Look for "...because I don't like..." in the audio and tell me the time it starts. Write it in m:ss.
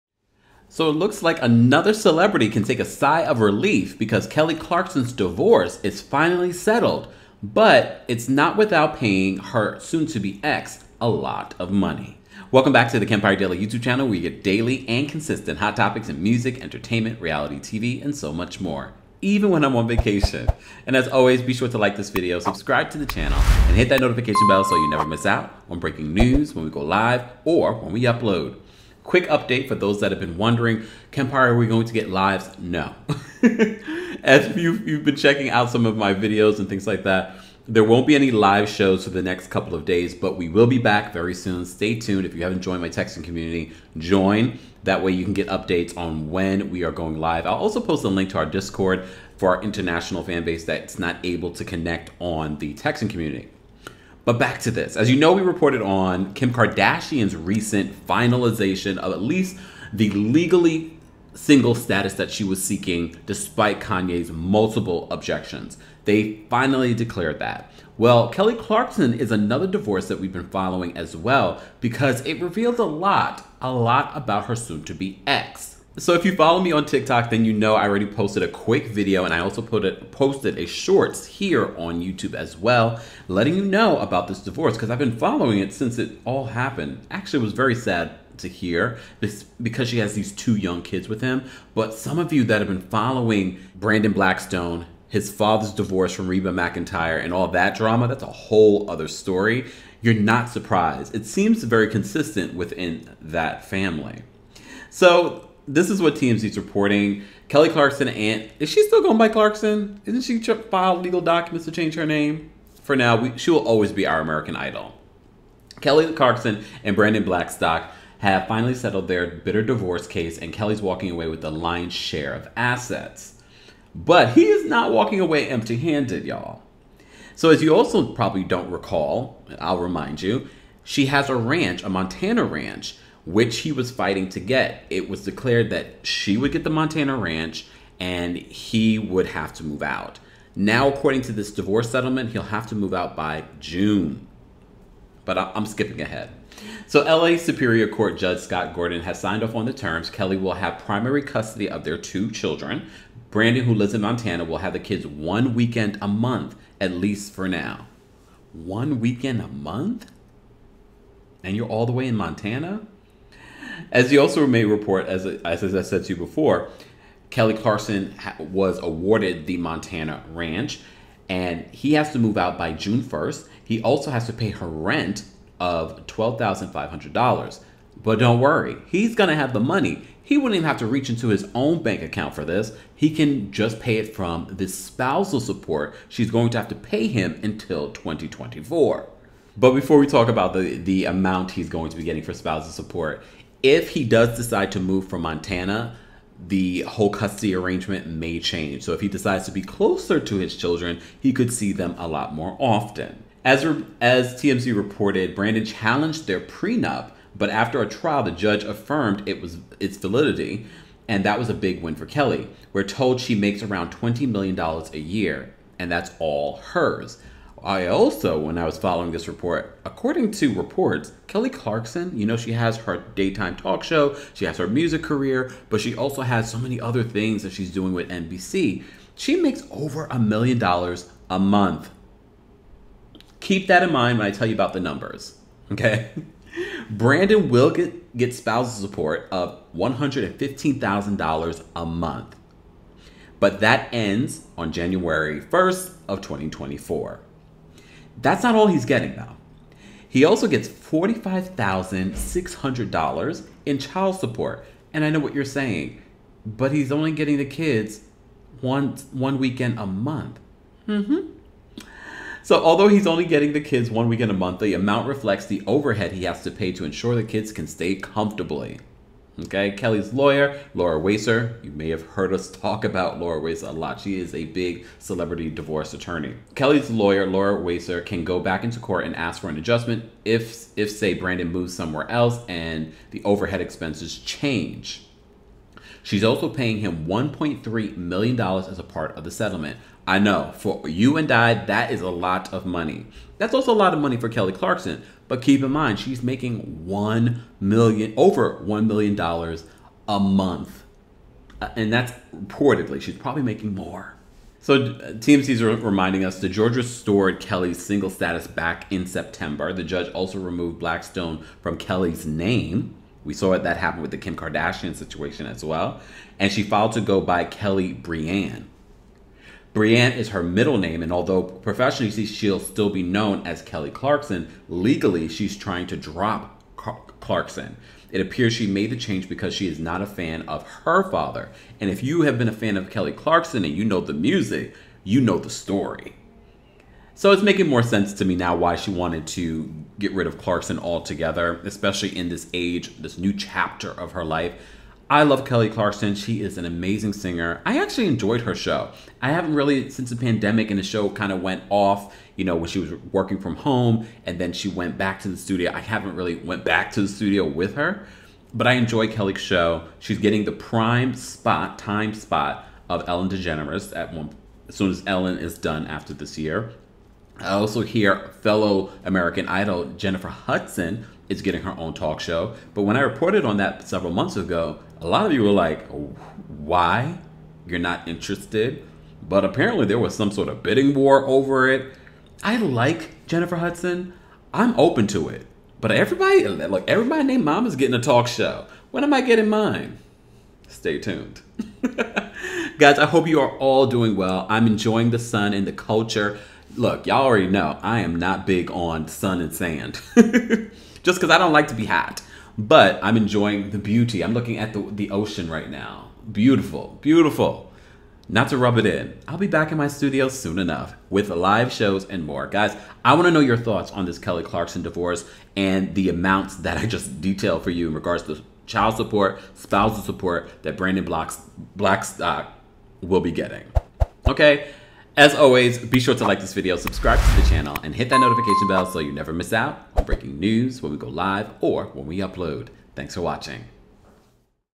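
6:41.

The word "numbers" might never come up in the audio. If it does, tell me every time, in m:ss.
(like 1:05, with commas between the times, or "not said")
3:54.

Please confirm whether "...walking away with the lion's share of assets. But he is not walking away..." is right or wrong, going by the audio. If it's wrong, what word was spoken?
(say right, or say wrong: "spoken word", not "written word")
right.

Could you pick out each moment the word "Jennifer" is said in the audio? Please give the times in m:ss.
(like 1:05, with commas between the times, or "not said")
6:09, 6:23.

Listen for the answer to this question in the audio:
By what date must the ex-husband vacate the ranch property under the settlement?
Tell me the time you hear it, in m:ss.
2:52.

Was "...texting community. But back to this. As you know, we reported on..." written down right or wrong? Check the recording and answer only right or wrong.
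right.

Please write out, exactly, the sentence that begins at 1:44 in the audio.
So this is what TMZ's reporting.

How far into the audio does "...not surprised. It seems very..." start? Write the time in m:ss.
1:40.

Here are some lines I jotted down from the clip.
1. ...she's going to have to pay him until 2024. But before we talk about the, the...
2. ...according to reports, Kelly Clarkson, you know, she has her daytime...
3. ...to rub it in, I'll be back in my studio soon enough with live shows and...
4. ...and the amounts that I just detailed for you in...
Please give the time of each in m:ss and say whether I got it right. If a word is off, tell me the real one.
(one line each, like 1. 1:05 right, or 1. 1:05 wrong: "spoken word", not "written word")
1. 3:06 right
2. 3:39 right
3. 6:48 right
4. 6:55 right.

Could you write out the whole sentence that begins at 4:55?
But keep in mind, she's making one million, over one million dollars a month, uh, and that's reportedly.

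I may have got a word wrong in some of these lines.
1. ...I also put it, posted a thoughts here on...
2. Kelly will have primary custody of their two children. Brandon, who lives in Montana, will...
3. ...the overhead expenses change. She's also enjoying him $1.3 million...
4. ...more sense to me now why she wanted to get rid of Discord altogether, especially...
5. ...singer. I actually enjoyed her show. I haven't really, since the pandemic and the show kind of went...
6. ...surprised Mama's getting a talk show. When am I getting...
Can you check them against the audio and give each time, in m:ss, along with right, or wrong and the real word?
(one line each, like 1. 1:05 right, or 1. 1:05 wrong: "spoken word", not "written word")
1. 1:19 wrong: "shorts", not "thoughts"
2. 2:30 right
3. 4:43 wrong: "paying", not "enjoying"
4. 5:37 wrong: "Clarkson", not "Discord"
5. 5:47 right
6. 6:27 wrong: "named", not "surprised".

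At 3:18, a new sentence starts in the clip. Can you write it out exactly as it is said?
So if he decides to be closer to his children, he could see them a lot more often.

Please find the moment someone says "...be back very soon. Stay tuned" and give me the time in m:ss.
0:40.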